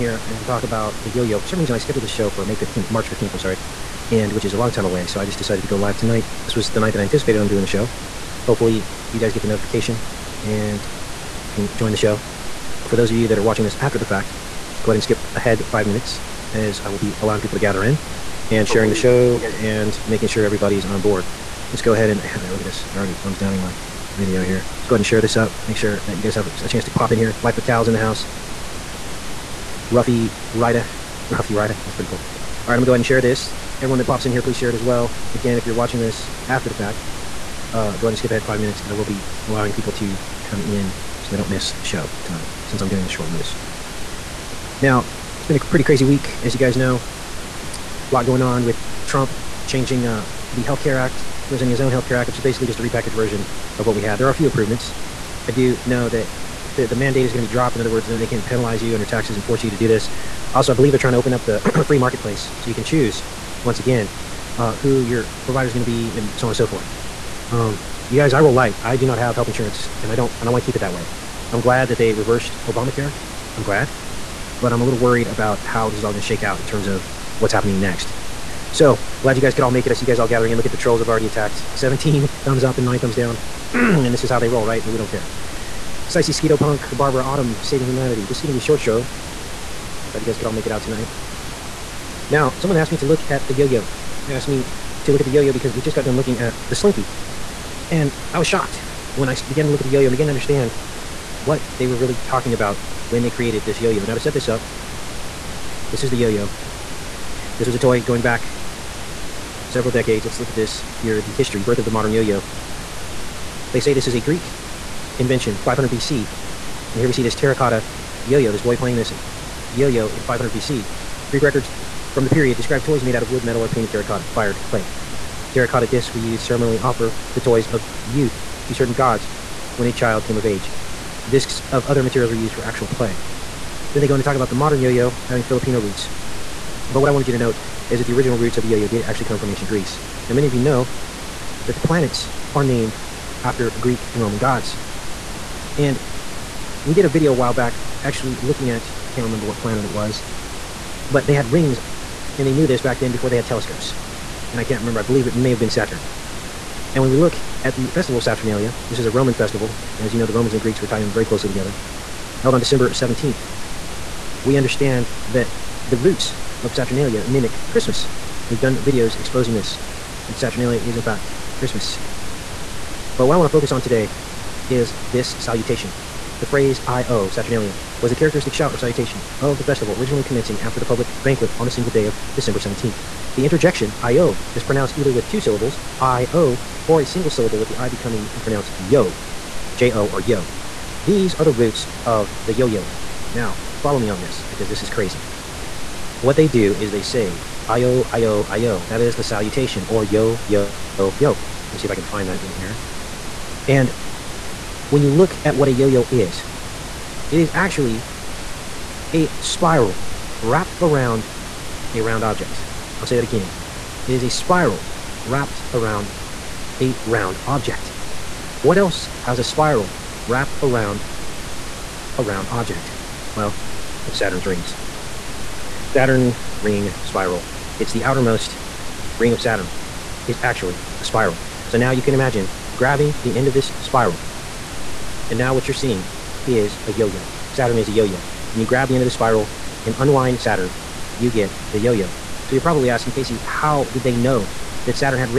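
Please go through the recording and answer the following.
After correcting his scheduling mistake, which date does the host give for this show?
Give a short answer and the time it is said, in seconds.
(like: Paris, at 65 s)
March 15th, at 2 s.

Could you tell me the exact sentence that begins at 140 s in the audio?
Now, many of you know that the planets are named after Greek and Roman gods.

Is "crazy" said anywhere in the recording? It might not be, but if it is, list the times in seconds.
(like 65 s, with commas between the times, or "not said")
45 s, 194 s.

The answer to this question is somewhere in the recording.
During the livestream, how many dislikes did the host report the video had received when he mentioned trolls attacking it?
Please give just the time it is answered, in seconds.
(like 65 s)
82 s.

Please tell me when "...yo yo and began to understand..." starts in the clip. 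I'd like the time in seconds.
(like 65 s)
99 s.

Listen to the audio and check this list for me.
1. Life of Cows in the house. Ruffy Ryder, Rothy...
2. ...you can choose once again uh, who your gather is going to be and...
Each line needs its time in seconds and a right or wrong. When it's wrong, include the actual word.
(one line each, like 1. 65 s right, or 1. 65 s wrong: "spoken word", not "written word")
1. 27 s right
2. 62 s wrong: "provider", not "gather".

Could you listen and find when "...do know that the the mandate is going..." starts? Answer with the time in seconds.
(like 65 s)
55 s.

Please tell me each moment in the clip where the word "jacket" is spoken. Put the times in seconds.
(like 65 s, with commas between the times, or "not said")
not said.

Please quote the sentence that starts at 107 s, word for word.
This was a toy going back several decades.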